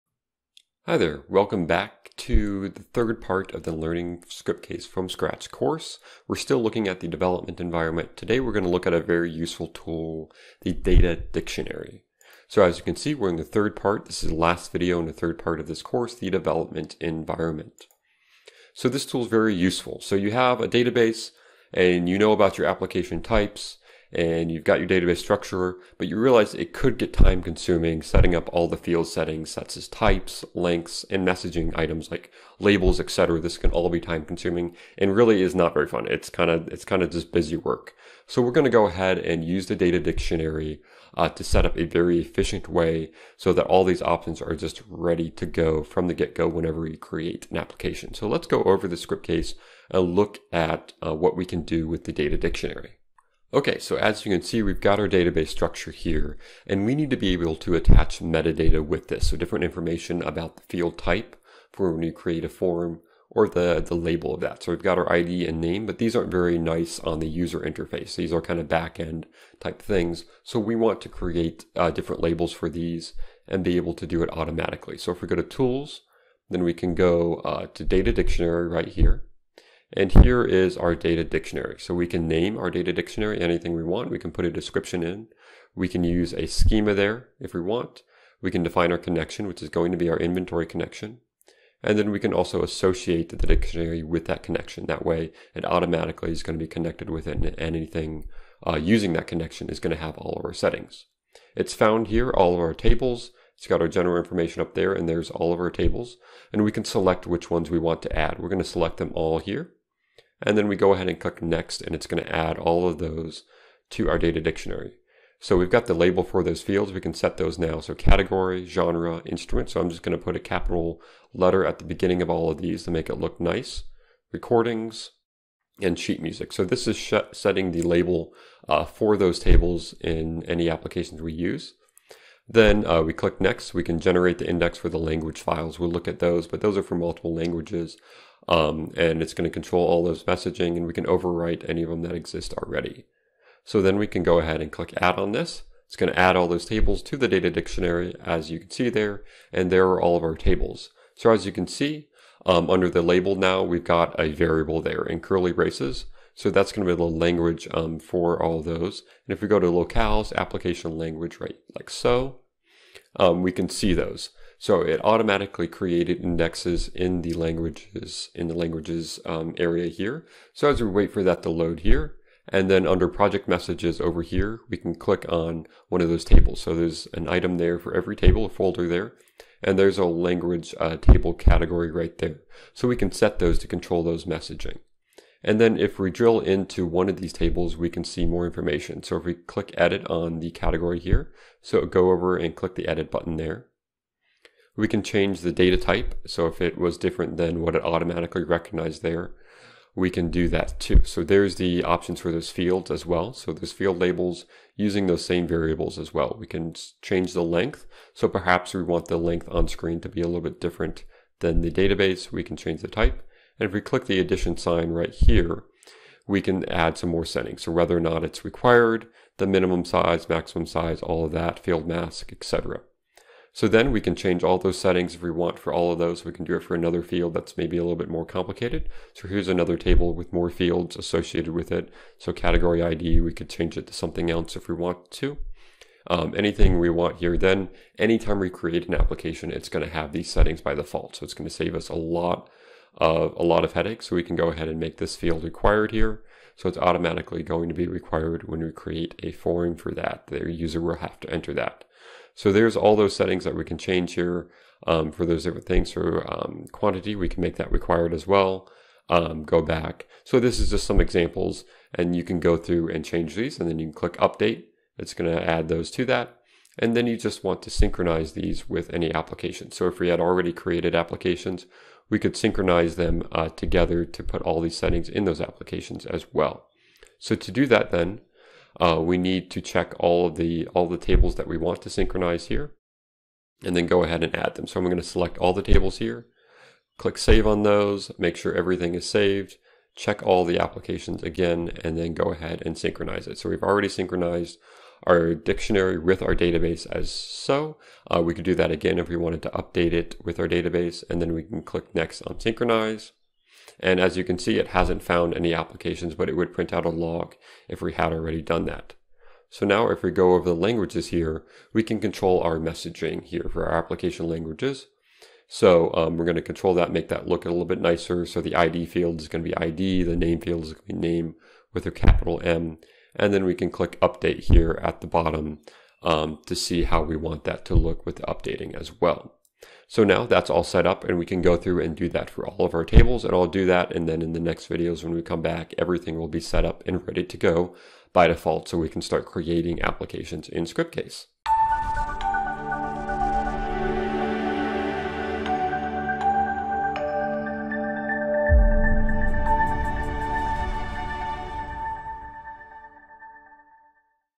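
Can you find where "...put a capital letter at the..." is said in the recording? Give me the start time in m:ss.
2:00.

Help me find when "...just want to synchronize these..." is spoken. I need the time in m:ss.
4:27.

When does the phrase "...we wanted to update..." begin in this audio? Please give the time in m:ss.
4:59.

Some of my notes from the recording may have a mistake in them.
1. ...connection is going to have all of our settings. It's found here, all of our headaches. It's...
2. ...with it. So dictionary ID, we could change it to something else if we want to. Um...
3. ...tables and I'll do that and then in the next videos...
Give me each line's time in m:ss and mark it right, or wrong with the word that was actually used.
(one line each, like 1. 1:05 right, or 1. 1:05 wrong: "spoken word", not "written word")
1. 1:39 wrong: "tables", not "headaches"
2. 3:51 wrong: "category", not "dictionary"
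3. 5:32 right.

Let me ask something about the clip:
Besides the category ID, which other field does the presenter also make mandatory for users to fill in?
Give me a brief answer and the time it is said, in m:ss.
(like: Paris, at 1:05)
quantity, at 4:16.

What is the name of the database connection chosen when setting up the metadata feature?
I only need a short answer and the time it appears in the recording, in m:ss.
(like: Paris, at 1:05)
inventory, at 1:30.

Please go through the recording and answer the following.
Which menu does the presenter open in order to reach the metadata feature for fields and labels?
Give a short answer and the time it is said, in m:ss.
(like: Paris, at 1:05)
Tools, at 1:15.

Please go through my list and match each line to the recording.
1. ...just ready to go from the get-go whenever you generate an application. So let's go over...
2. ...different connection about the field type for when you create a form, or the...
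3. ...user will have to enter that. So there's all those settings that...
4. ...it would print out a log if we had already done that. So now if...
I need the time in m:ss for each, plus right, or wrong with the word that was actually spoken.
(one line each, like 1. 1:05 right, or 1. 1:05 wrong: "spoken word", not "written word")
1. 0:44 wrong: "create", not "generate"
2. 0:59 wrong: "information", not "connection"
3. 4:10 right
4. 5:06 right.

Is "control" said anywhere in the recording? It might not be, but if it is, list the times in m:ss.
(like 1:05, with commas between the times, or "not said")
2:19, 3:03, 5:11, 5:16.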